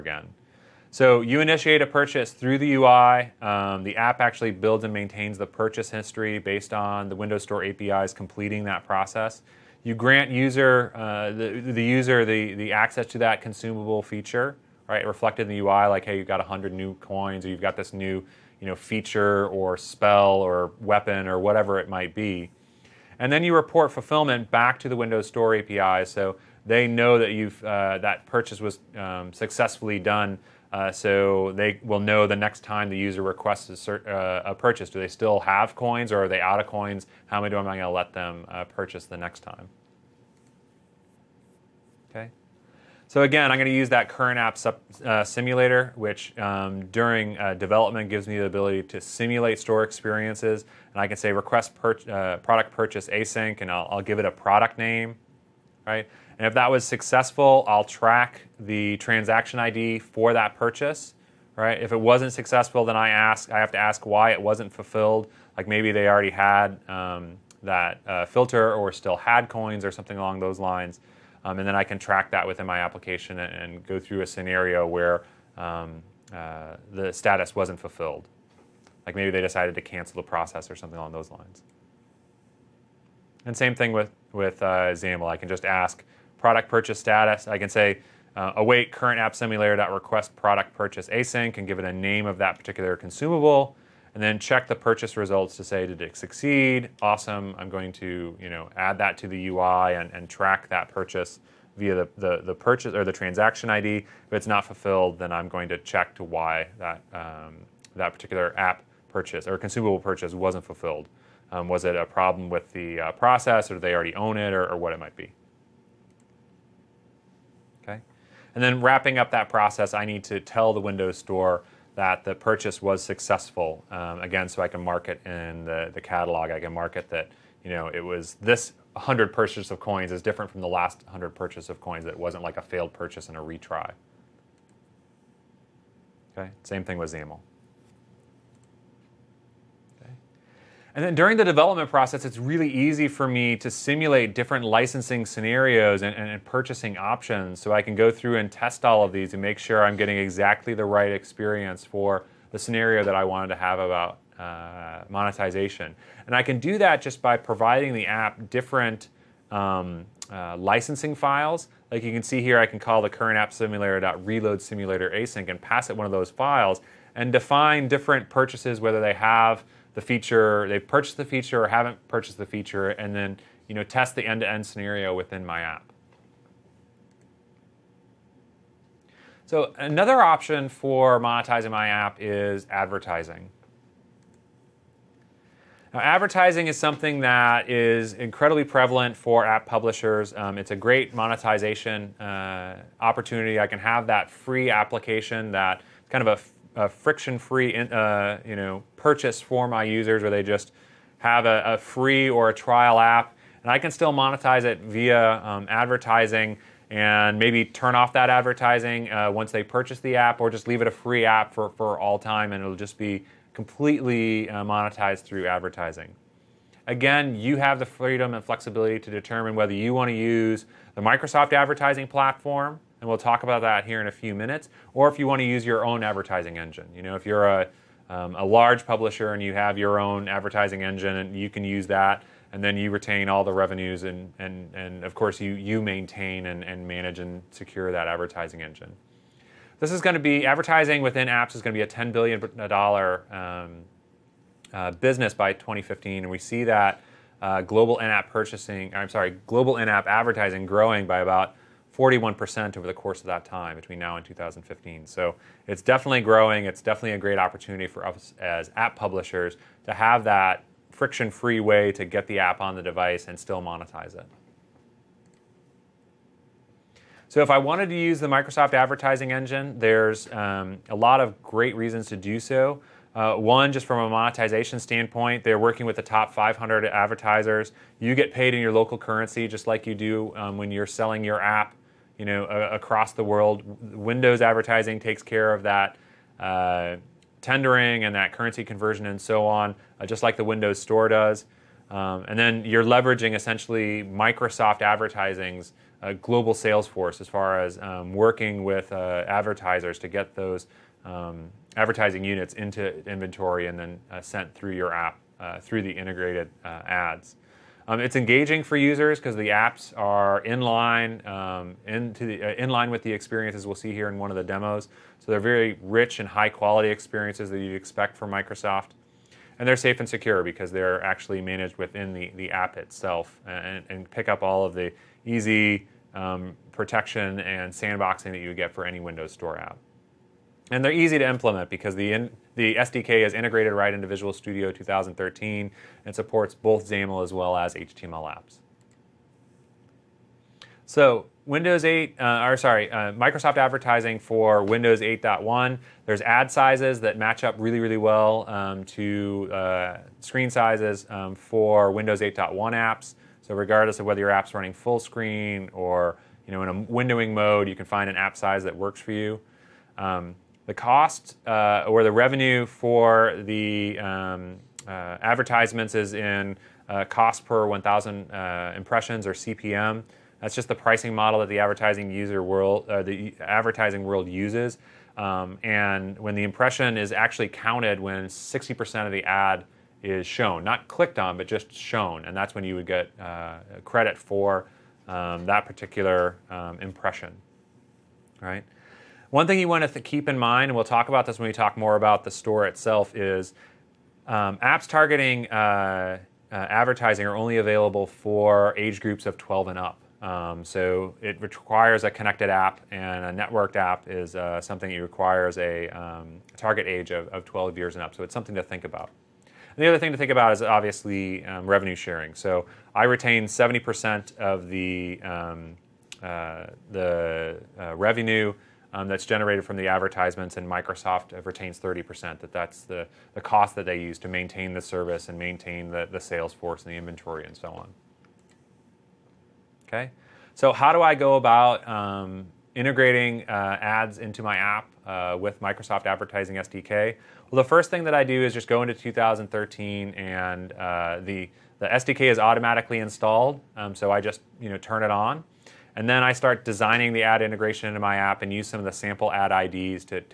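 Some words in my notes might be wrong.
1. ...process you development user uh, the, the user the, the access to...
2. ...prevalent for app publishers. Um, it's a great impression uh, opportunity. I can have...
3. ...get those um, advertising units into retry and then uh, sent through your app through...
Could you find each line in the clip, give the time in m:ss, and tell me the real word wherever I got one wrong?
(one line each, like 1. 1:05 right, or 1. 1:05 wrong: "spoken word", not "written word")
1. 0:08 wrong: "grant", not "development"
2. 3:08 wrong: "monetization", not "impression"
3. 5:00 wrong: "inventory", not "retry".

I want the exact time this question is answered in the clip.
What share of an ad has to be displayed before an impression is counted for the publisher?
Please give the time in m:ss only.
6:18.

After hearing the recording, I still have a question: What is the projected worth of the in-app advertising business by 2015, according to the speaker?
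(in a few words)
$10 billion.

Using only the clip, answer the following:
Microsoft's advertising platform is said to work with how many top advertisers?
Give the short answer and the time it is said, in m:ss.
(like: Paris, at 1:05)
500, at 4:36.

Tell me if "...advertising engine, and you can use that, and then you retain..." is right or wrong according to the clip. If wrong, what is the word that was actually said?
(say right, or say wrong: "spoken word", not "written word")
right.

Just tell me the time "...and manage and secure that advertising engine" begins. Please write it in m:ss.
3:56.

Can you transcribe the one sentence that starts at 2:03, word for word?
Um, again, so I can mark it in the, the catalog.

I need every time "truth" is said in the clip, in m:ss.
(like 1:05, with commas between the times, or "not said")
not said.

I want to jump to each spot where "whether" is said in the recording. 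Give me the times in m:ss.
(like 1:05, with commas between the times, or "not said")
2:48, 3:39, 5:54.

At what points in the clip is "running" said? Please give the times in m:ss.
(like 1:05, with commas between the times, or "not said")
5:54.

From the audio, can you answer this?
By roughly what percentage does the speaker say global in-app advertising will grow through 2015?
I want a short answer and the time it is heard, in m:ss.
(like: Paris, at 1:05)
41%, at 4:11.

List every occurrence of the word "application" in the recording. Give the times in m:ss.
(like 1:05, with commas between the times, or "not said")
1:12, 3:14.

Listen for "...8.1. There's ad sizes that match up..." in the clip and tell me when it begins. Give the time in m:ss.
5:44.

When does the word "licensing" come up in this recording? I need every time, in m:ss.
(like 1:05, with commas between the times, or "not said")
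2:24, 2:40.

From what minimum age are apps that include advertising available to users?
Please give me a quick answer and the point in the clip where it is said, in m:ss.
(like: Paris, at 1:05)
12, at 6:39.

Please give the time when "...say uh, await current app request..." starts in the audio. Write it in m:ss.
1:27.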